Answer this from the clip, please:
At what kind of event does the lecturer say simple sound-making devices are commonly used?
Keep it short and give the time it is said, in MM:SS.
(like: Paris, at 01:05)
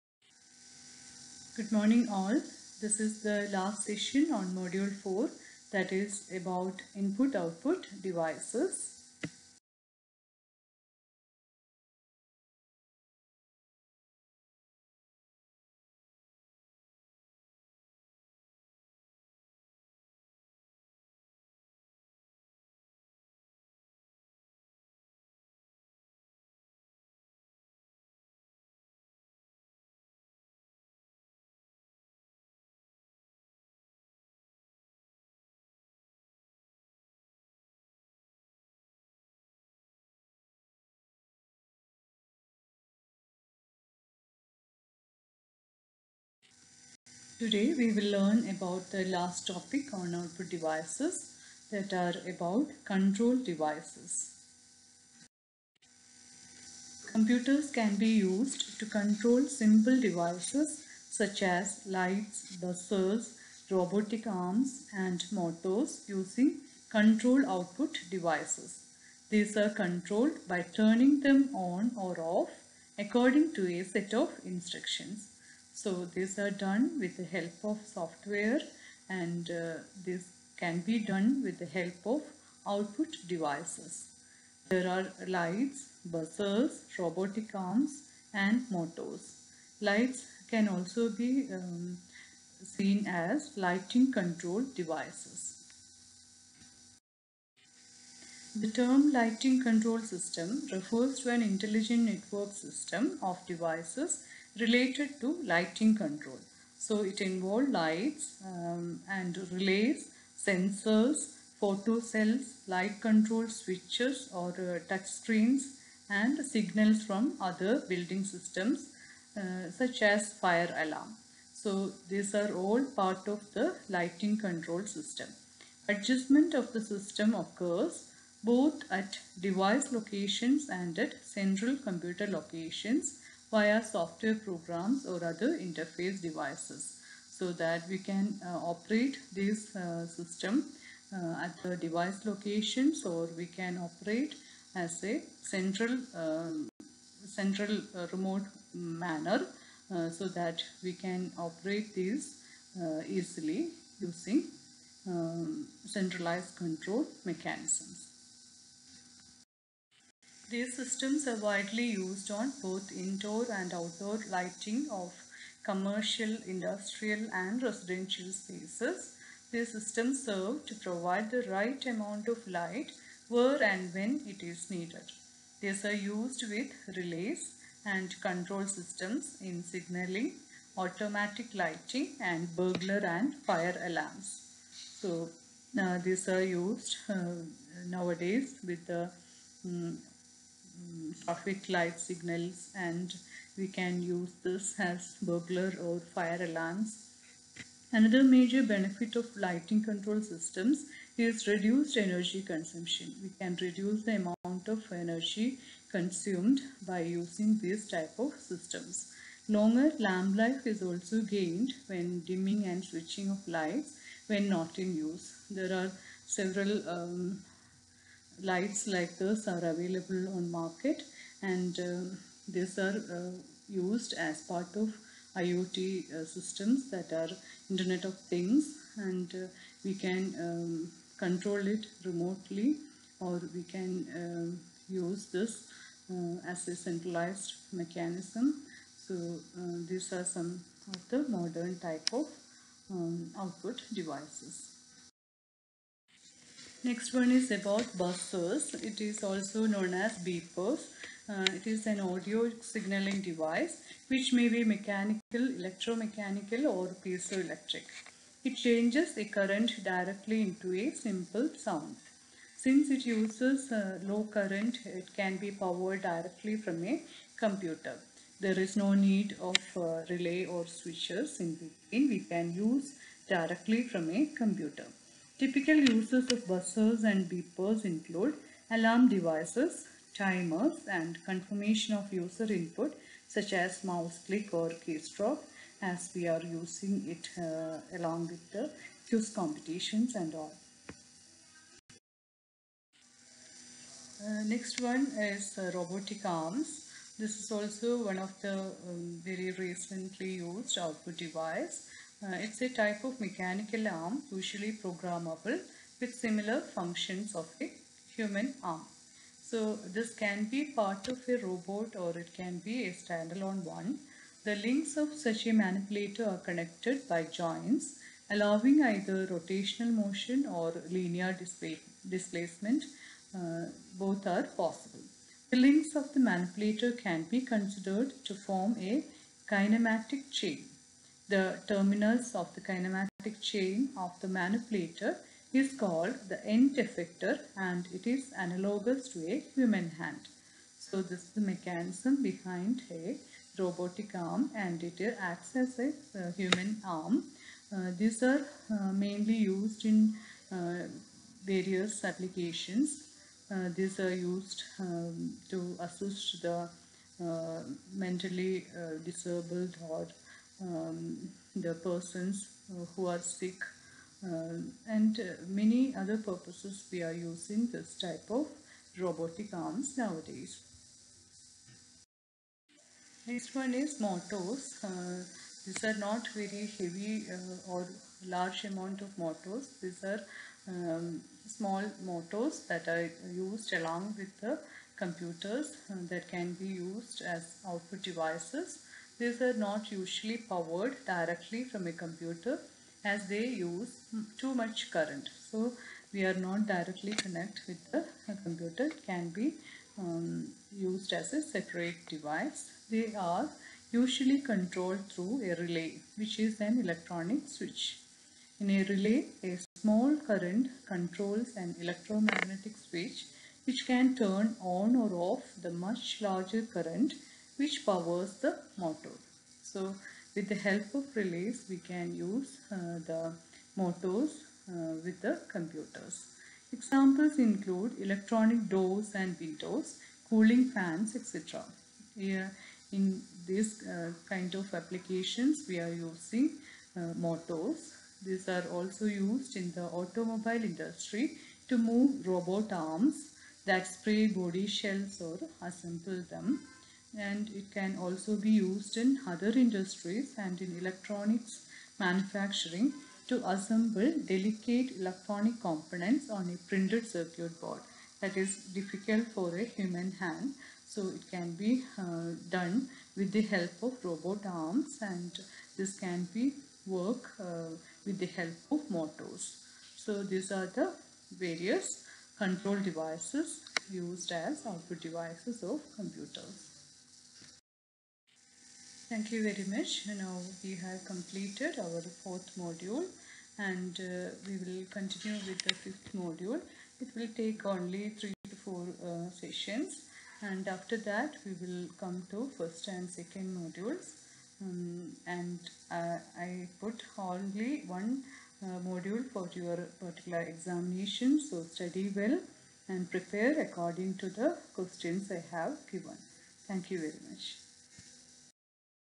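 quiz competitions, at 04:49.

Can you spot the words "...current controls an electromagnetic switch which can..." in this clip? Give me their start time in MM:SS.
06:50.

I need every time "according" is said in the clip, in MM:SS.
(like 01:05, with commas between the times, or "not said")
01:12, 08:23.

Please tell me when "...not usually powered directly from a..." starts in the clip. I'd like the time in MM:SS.
06:29.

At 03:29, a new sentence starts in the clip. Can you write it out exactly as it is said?
Longer lamp life is also gained when dimming and switching of lights when not in use.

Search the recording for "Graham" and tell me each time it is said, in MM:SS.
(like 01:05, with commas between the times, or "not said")
not said.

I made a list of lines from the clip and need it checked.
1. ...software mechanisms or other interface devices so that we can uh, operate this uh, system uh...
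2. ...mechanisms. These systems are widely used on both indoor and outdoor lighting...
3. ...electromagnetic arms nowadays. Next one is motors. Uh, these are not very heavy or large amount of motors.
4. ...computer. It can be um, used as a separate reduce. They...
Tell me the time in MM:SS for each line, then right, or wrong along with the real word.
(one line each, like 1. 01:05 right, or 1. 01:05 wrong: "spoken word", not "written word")
1. 02:13 wrong: "programs", not "mechanisms"
2. 02:37 right
3. 06:08 wrong: "robotic", not "electromagnetic"
4. 06:38 wrong: "device", not "reduce".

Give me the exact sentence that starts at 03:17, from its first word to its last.
Another major benefit of lighting control systems is reduced energy consumption.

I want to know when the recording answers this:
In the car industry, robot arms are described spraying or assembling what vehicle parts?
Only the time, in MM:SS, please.
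07:24.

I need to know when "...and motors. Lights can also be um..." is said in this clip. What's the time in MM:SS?
01:28.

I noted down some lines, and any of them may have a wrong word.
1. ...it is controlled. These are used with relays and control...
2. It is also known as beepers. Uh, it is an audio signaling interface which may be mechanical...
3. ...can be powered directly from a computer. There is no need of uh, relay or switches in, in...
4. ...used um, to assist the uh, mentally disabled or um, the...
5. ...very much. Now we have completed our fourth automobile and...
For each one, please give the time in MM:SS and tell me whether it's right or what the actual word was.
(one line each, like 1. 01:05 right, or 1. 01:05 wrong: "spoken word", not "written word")
1. 02:54 wrong: "needed", not "controlled"
2. 04:08 wrong: "device", not "interface"
3. 04:25 right
4. 05:54 right
5. 07:59 wrong: "module", not "automobile".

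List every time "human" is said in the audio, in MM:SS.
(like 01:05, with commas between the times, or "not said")
05:08, 05:39, 05:46, 07:39.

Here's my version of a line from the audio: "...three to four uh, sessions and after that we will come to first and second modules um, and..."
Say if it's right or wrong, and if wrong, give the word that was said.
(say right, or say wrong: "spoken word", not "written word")
right.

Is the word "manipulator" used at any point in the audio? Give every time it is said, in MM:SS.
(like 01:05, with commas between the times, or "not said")
05:15, 05:26, 05:34.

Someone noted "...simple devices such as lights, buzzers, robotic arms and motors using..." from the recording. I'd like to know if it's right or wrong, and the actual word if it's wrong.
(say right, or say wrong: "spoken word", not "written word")
right.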